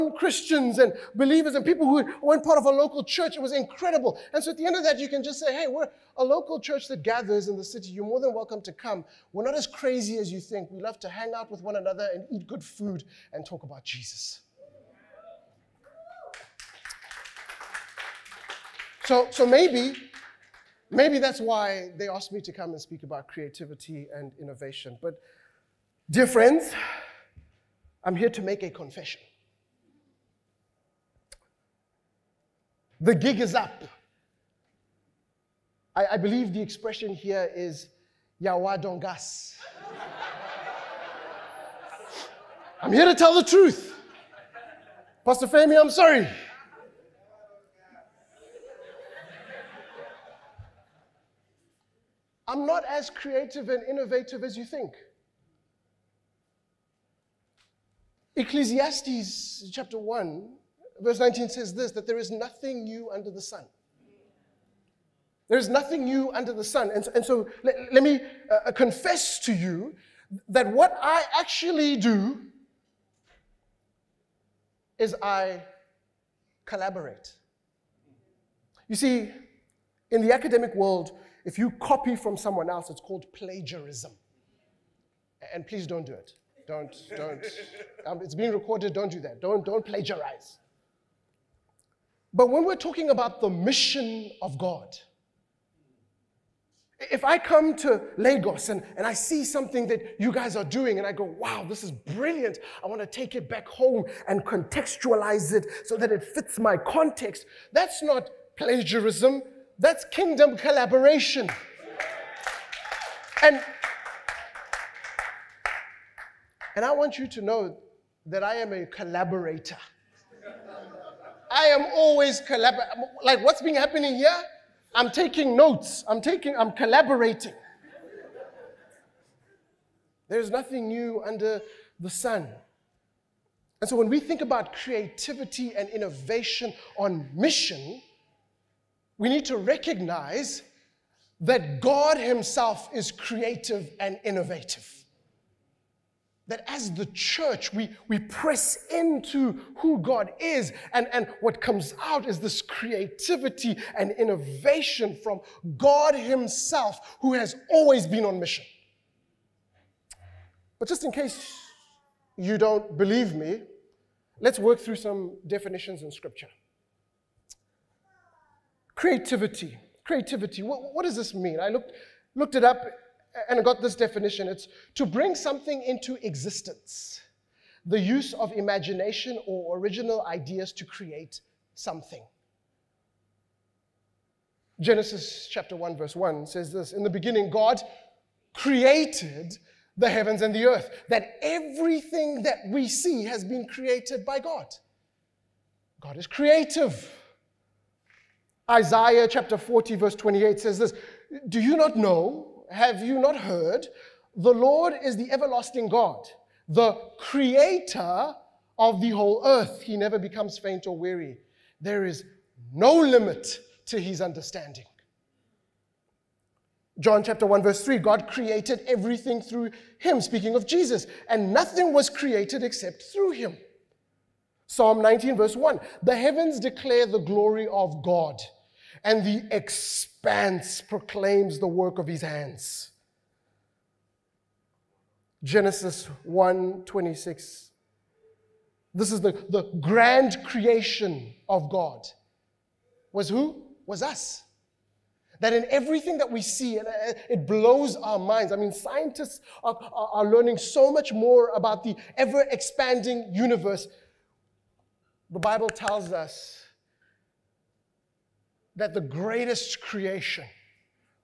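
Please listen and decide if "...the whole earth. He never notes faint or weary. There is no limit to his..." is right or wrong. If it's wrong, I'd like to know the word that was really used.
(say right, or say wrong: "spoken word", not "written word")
wrong: "becomes", not "notes".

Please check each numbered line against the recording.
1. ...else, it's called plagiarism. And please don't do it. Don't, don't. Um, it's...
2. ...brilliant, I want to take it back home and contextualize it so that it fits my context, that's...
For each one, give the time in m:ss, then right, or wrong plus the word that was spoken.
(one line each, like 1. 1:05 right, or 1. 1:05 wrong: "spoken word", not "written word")
1. 1:22 right
2. 1:41 right.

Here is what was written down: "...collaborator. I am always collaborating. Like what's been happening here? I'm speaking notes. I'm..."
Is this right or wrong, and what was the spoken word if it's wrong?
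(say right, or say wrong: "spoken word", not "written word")
wrong: "taking", not "speaking".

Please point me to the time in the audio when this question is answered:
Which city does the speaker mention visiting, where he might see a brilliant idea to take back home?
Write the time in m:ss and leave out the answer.
1:38.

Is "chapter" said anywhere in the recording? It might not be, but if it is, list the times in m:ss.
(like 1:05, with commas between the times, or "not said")
0:59, 3:05, 3:19, 3:37.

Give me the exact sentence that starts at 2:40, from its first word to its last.
But just in case you don't believe me, let's work through some definitions in Scripture.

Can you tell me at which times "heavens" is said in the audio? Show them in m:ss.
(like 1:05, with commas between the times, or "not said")
3:10, 3:46.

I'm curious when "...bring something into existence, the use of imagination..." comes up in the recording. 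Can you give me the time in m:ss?
2:55.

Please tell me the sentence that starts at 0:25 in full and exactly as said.
But, dear friends, I'm here to make a confession.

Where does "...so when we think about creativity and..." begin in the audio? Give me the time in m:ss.
2:13.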